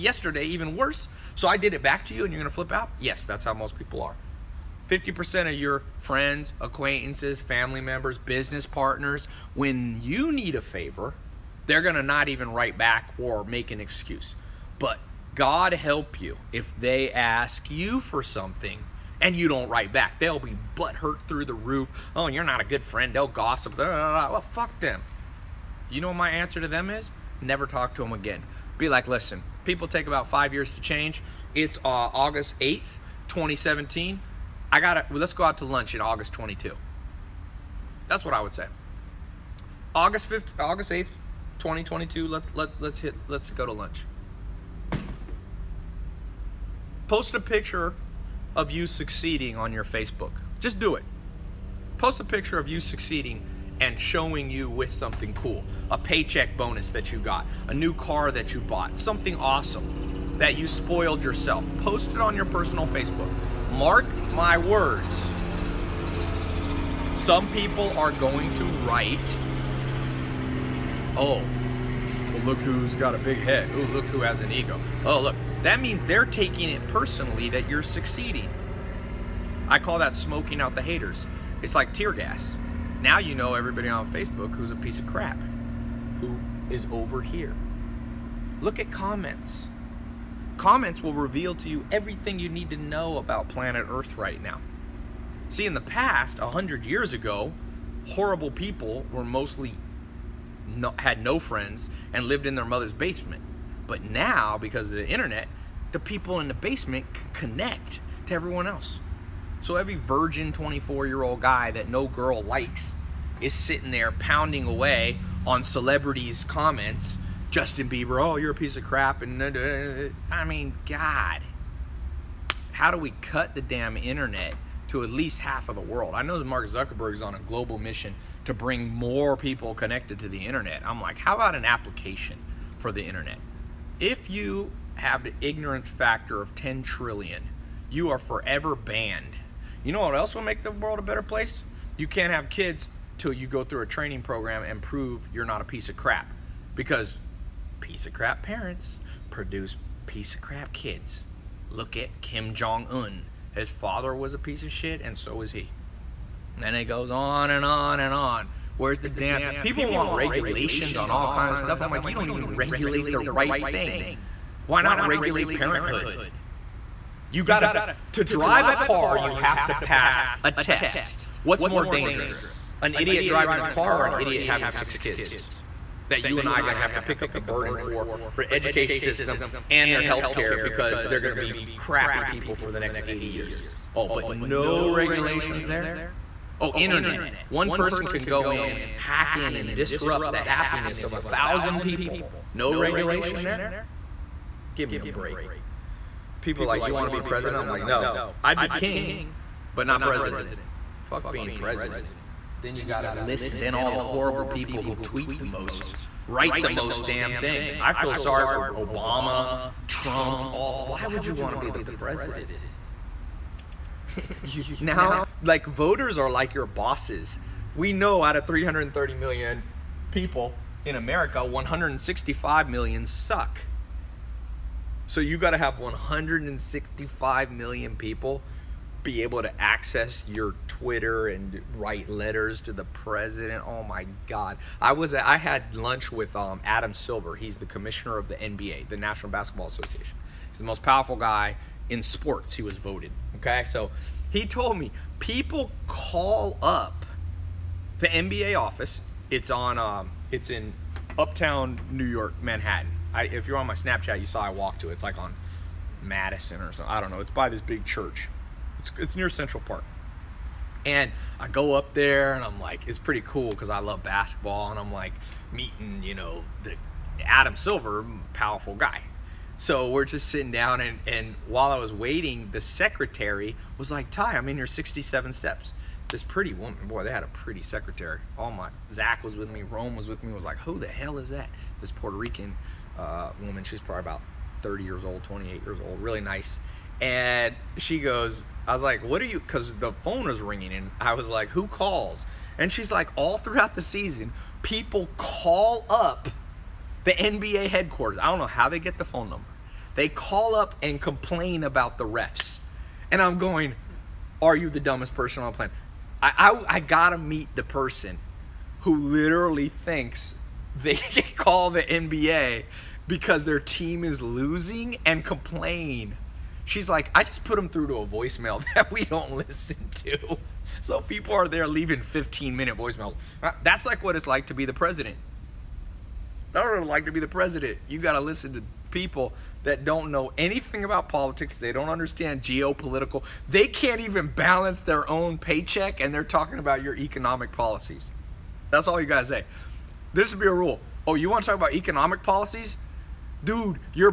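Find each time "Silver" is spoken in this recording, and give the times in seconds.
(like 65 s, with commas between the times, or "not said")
236 s, 267 s.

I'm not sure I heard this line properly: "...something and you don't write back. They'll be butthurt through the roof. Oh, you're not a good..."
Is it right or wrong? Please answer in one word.
right.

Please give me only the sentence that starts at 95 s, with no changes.
See, in the past, 100 years ago, horrible people were mostly no, had no friends and lived in their mother's basement.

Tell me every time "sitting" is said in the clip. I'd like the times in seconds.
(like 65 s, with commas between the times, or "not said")
113 s, 270 s.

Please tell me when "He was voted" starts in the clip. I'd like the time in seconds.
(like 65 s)
242 s.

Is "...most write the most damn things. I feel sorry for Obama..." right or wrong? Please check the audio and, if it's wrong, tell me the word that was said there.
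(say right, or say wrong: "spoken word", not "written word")
right.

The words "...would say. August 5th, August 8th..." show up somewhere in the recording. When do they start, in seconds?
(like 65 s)
38 s.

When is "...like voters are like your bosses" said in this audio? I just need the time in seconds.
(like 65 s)
215 s.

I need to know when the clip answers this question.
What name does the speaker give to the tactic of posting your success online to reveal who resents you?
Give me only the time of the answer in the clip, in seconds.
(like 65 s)
80 s.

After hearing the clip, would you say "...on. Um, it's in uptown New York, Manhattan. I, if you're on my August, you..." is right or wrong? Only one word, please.
wrong.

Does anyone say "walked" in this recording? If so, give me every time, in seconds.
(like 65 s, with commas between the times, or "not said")
254 s.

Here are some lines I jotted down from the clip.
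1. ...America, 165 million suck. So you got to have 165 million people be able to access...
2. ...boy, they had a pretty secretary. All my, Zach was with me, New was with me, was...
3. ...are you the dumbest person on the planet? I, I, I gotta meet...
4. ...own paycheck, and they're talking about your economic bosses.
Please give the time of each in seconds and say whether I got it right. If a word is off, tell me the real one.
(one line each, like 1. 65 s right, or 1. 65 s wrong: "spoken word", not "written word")
1. 220 s right
2. 276 s wrong: "Rome", not "New"
3. 304 s right
4. 335 s wrong: "policies", not "bosses".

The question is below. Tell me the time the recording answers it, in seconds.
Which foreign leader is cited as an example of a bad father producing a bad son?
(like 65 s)
152 s.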